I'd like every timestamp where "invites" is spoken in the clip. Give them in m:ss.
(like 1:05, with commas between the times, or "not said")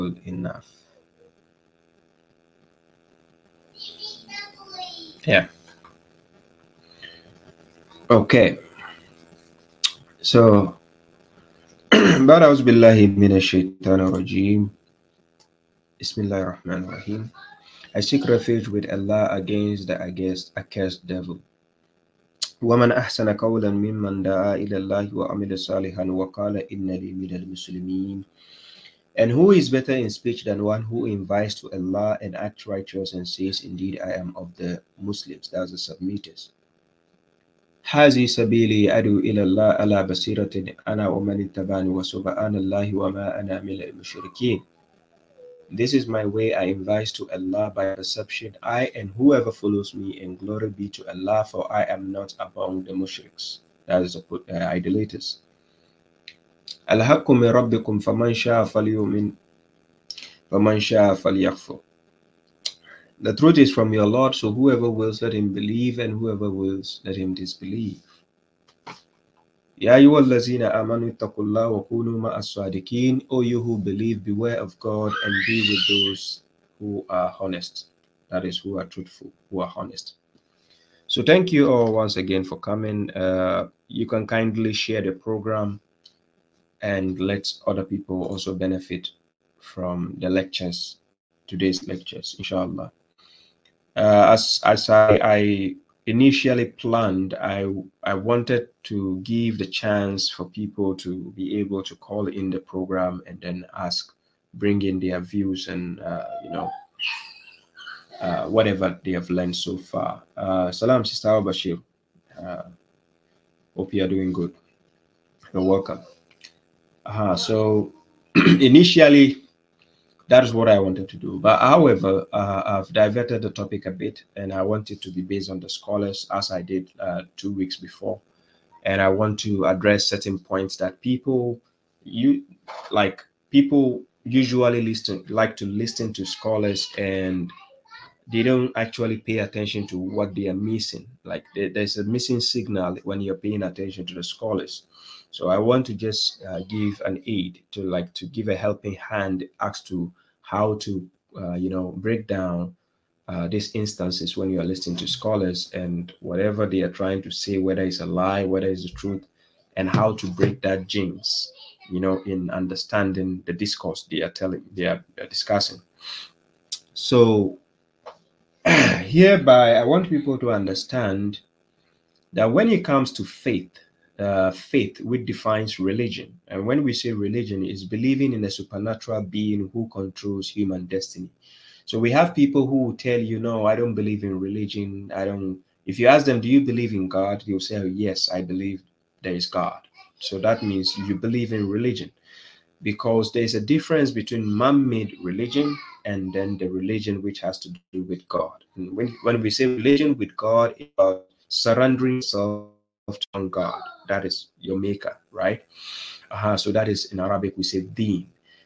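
0:31, 0:46.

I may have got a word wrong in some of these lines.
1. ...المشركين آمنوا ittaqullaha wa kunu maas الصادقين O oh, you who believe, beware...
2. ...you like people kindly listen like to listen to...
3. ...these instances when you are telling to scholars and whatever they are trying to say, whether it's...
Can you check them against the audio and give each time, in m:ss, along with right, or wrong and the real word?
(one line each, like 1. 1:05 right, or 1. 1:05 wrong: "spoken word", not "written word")
1. 1:09 wrong: "الذين", not "المشركين"
2. 2:12 wrong: "usually", not "kindly"
3. 2:33 wrong: "listening", not "telling".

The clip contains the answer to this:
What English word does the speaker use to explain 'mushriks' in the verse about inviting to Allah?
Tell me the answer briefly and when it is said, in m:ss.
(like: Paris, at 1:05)
idolaters, at 0:54.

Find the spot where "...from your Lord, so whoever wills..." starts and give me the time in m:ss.
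1:03.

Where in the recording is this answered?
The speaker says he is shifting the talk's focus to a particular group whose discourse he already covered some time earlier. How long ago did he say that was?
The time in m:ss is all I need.
2:07.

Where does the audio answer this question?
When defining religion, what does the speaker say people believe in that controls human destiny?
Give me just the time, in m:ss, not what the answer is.
2:58.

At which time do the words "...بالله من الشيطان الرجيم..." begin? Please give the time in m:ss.
0:12.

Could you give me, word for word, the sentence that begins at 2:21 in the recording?
Like there's a missing signal when you're paying attention to the scholars.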